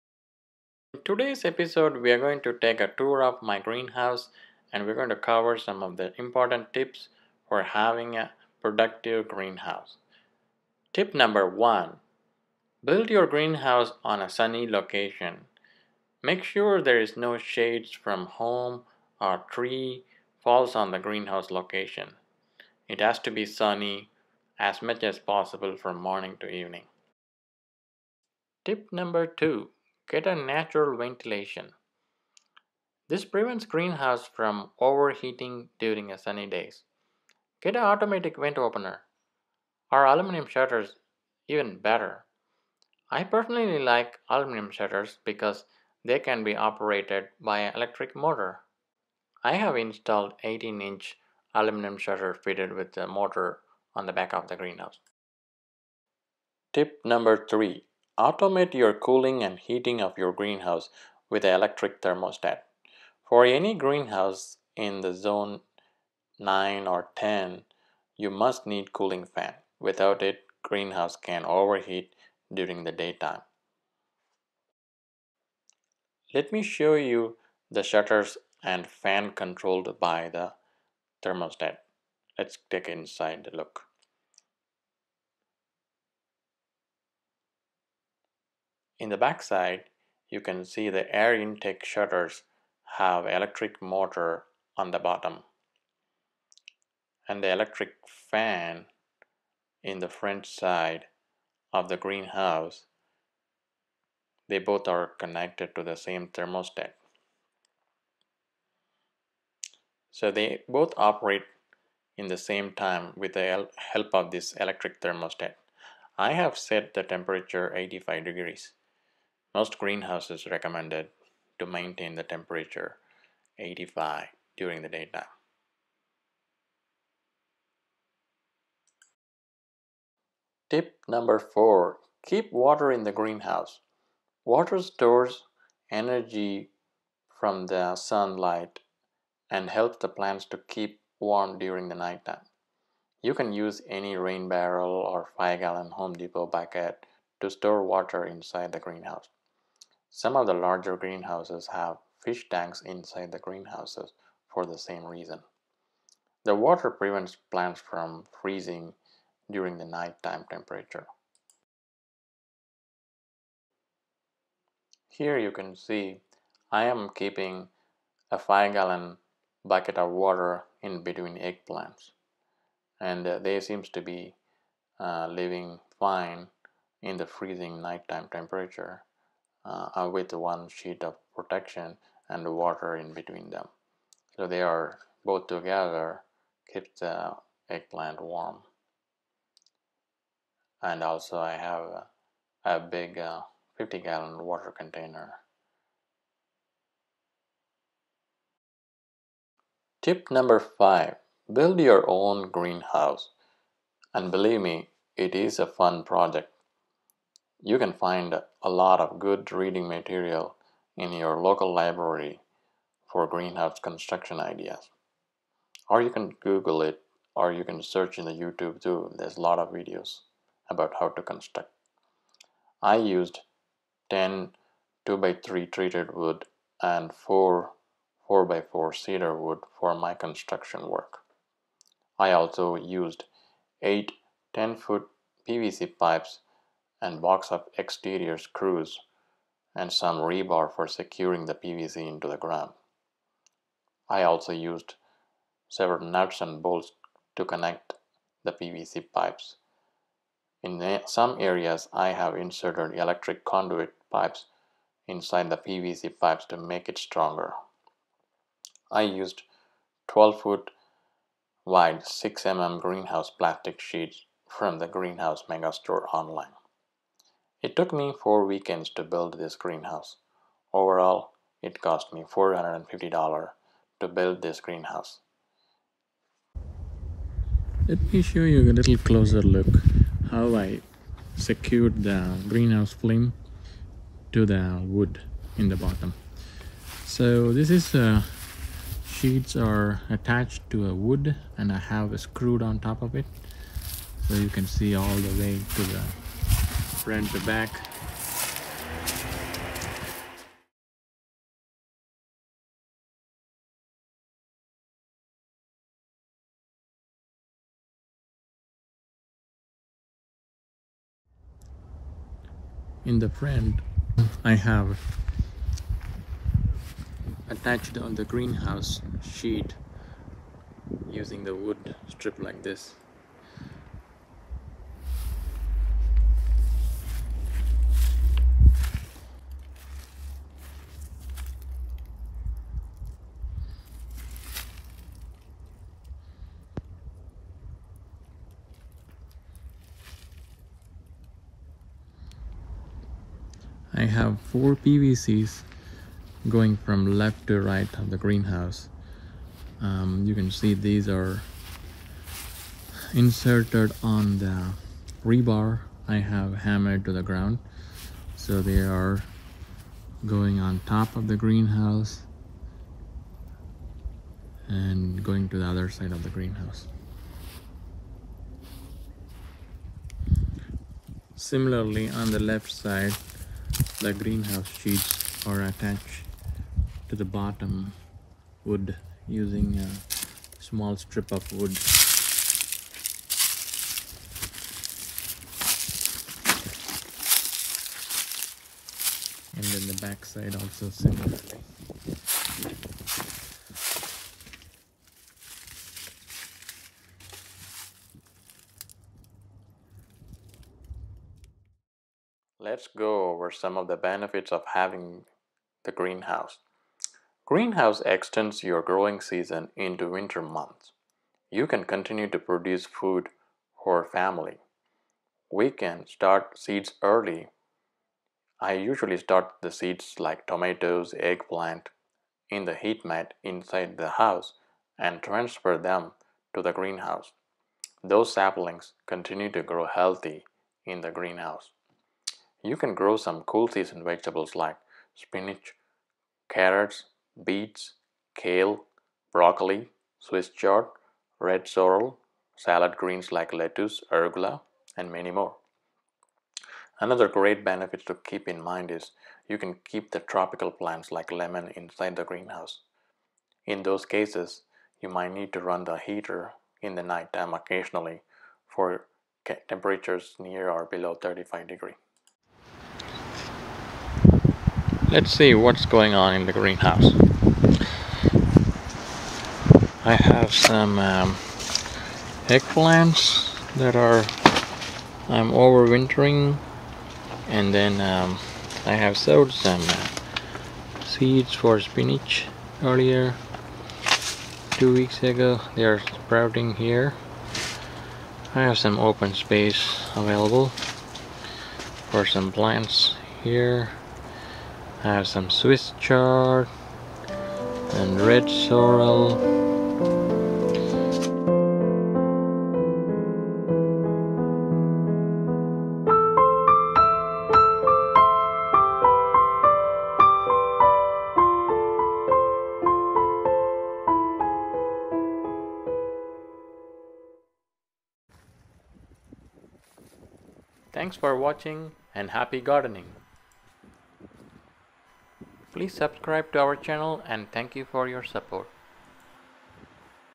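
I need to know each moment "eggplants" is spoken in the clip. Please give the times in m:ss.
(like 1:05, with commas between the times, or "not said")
2:51, 3:07, 7:01, 7:52.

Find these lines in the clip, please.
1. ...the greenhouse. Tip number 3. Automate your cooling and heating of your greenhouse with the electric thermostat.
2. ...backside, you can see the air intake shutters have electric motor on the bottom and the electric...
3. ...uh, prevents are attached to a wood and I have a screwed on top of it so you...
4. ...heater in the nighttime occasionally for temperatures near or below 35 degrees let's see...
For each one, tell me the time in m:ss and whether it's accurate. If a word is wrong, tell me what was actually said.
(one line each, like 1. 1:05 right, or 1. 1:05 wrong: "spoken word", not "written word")
1. 0:54 right
2. 1:29 right
3. 4:47 wrong: "sheets", not "prevents"
4. 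7:35 right.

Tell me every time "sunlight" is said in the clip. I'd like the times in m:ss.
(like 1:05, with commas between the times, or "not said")
2:17.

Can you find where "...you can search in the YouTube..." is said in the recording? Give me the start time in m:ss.
3:37.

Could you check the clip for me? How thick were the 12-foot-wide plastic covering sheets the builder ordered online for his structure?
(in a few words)
6 mm.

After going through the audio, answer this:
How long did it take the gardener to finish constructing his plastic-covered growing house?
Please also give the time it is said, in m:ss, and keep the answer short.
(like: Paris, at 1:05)
4 weekends, at 4:28.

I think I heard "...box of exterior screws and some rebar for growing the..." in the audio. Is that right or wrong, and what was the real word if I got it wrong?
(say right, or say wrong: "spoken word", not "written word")
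wrong: "securing", not "growing".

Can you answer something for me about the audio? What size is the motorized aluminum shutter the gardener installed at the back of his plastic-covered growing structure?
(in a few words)
18 inch.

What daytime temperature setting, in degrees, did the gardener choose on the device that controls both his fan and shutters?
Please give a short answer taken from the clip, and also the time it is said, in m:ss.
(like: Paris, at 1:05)
85, at 1:57.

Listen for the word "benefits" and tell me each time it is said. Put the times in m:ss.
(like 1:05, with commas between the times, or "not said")
6:43, 7:27.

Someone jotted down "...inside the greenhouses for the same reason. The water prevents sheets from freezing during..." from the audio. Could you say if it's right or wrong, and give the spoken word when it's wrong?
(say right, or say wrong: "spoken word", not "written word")
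wrong: "plants", not "sheets".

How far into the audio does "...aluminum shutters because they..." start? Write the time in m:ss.
0:44.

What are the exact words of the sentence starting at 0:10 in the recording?
Tip number one build your greenhouse on a sunny location.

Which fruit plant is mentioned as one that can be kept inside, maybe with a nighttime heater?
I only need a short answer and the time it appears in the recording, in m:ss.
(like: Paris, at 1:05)
lemon, at 7:31.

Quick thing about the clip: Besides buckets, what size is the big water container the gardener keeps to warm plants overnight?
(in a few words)
50 gallon.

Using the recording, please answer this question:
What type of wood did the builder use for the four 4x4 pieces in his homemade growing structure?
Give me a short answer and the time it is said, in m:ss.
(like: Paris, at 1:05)
cedar, at 3:48.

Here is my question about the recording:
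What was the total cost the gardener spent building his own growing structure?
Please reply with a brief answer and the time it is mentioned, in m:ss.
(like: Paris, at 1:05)
$450, at 4:32.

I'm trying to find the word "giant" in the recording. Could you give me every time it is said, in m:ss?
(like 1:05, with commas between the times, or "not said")
not said.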